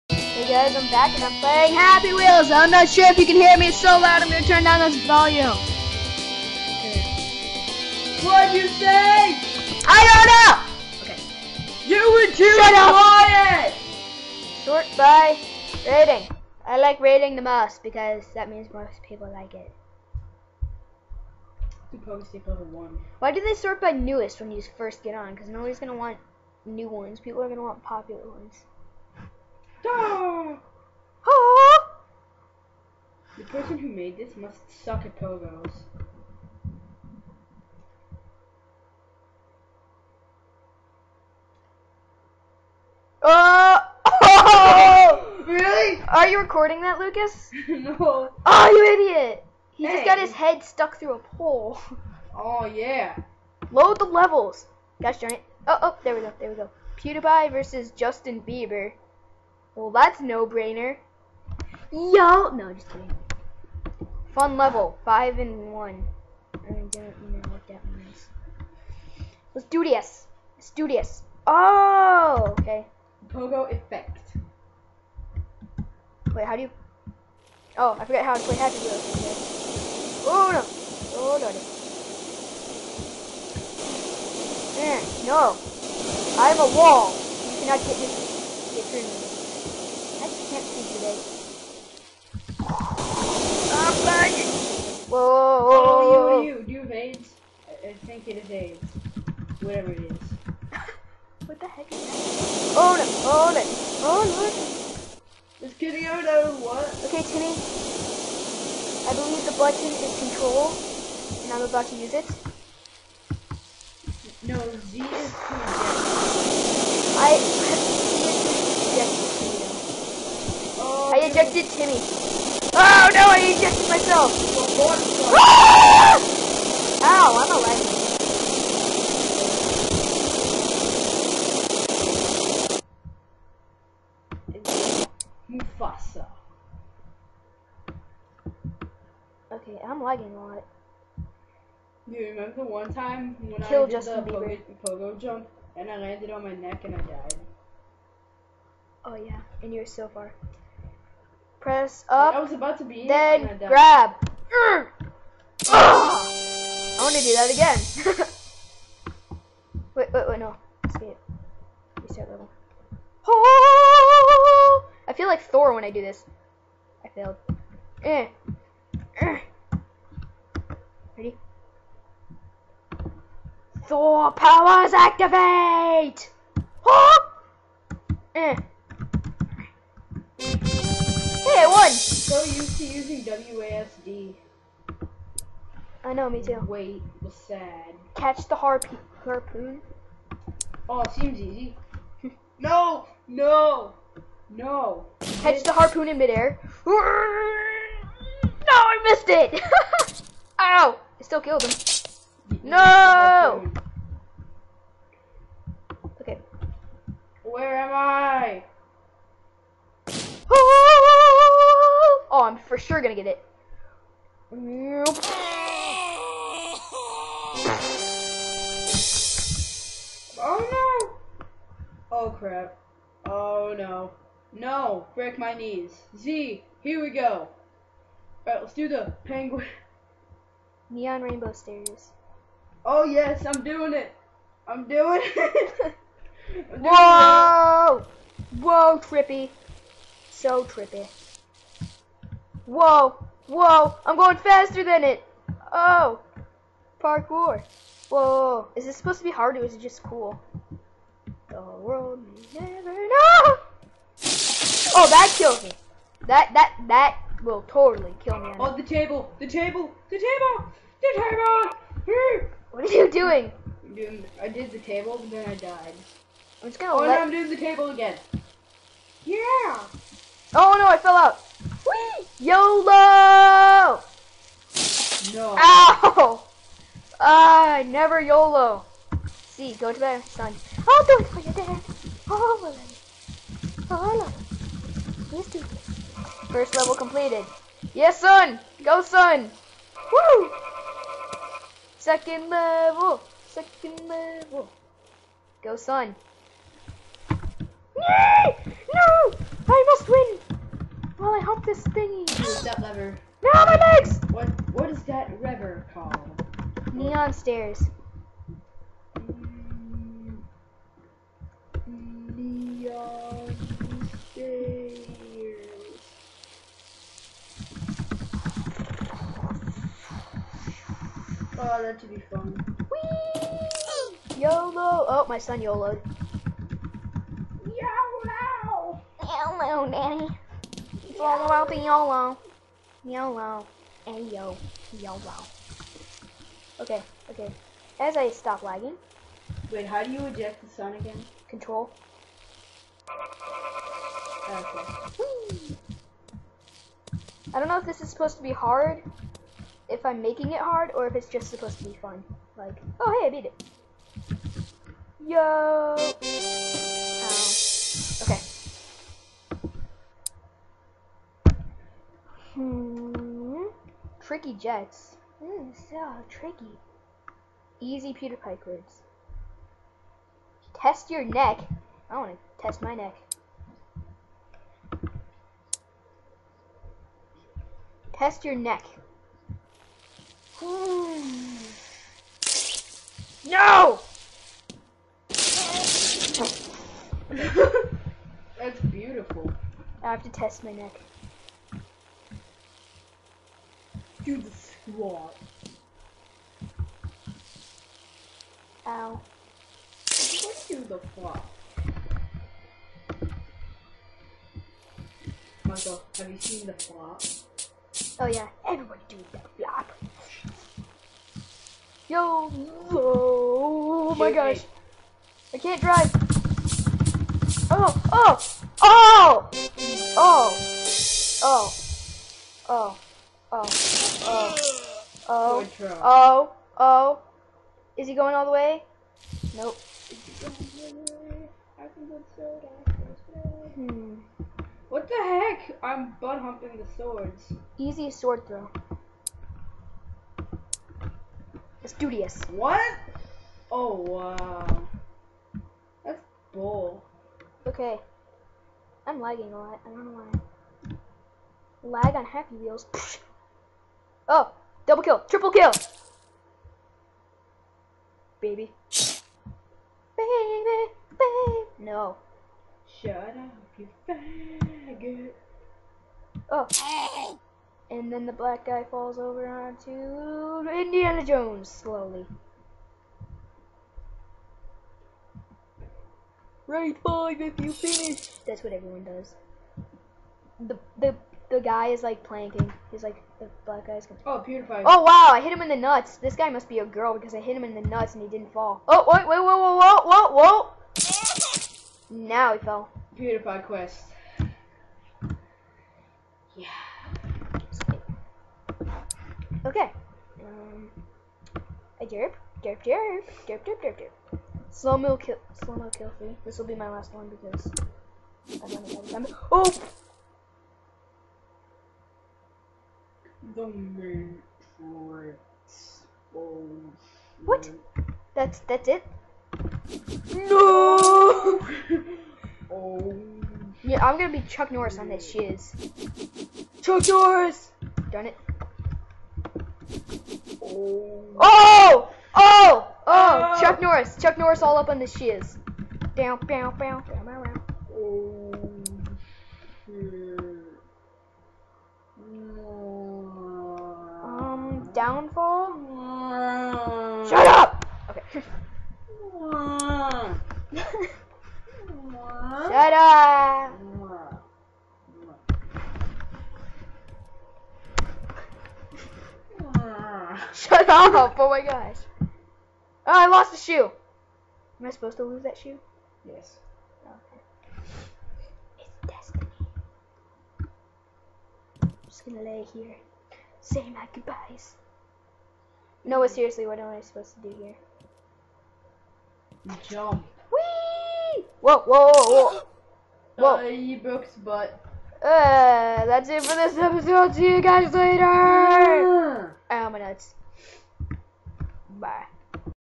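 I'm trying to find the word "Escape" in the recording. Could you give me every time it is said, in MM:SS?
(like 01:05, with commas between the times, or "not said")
02:40.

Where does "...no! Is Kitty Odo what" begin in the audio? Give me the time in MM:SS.
01:44.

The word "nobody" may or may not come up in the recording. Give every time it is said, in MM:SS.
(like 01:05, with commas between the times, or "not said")
00:25.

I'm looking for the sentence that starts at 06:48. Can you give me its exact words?
Oh yeah, everybody do the flop.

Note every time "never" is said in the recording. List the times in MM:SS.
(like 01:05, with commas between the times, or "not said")
04:12, 04:37.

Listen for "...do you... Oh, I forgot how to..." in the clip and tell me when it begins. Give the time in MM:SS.
01:16.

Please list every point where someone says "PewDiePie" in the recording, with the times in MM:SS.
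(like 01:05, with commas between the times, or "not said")
00:56, 08:04, 08:13.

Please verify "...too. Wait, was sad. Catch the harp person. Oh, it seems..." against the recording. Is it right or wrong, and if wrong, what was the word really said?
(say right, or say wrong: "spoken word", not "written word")
wrong: "harpoon", not "person".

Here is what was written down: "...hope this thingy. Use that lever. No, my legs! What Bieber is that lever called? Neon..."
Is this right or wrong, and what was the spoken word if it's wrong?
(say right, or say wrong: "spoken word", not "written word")
wrong: "What", not "Bieber".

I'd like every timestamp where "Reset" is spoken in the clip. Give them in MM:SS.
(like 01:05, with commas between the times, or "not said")
02:42.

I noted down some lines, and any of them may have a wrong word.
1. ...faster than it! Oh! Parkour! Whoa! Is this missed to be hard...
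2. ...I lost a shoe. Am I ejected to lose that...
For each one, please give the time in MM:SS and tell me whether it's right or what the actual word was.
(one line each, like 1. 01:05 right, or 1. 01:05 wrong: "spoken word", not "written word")
1. 04:04 wrong: "supposed", not "missed"
2. 09:23 wrong: "supposed", not "ejected".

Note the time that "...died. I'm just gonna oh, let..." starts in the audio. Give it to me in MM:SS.
04:25.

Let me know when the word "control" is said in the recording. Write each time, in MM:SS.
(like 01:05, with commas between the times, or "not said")
01:50, 05:41.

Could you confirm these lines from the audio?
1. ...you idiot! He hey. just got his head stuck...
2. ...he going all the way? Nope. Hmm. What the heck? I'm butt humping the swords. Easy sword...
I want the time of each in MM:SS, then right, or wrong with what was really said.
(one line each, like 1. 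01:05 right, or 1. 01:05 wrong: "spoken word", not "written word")
1. 00:48 right
2. 07:08 right.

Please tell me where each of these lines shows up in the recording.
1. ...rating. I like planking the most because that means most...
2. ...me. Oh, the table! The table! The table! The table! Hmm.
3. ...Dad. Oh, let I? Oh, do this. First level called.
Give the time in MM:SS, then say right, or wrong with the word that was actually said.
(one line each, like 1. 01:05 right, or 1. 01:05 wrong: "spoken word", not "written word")
1. 00:15 wrong: "rating", not "planking"
2. 04:18 right
3. 04:41 wrong: "completed", not "called".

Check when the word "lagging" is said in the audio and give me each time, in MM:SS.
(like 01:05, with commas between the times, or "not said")
01:34, 02:20, 05:38, 07:29.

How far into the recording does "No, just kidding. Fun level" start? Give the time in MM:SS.
01:02.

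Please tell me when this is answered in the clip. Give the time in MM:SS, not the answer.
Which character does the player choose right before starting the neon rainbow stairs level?
03:49.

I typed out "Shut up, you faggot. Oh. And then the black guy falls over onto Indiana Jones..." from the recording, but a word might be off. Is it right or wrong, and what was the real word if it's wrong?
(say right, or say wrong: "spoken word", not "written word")
right.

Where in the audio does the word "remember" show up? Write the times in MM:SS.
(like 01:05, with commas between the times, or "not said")
02:22, 08:29.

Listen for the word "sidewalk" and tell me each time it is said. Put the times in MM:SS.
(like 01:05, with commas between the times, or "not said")
not said.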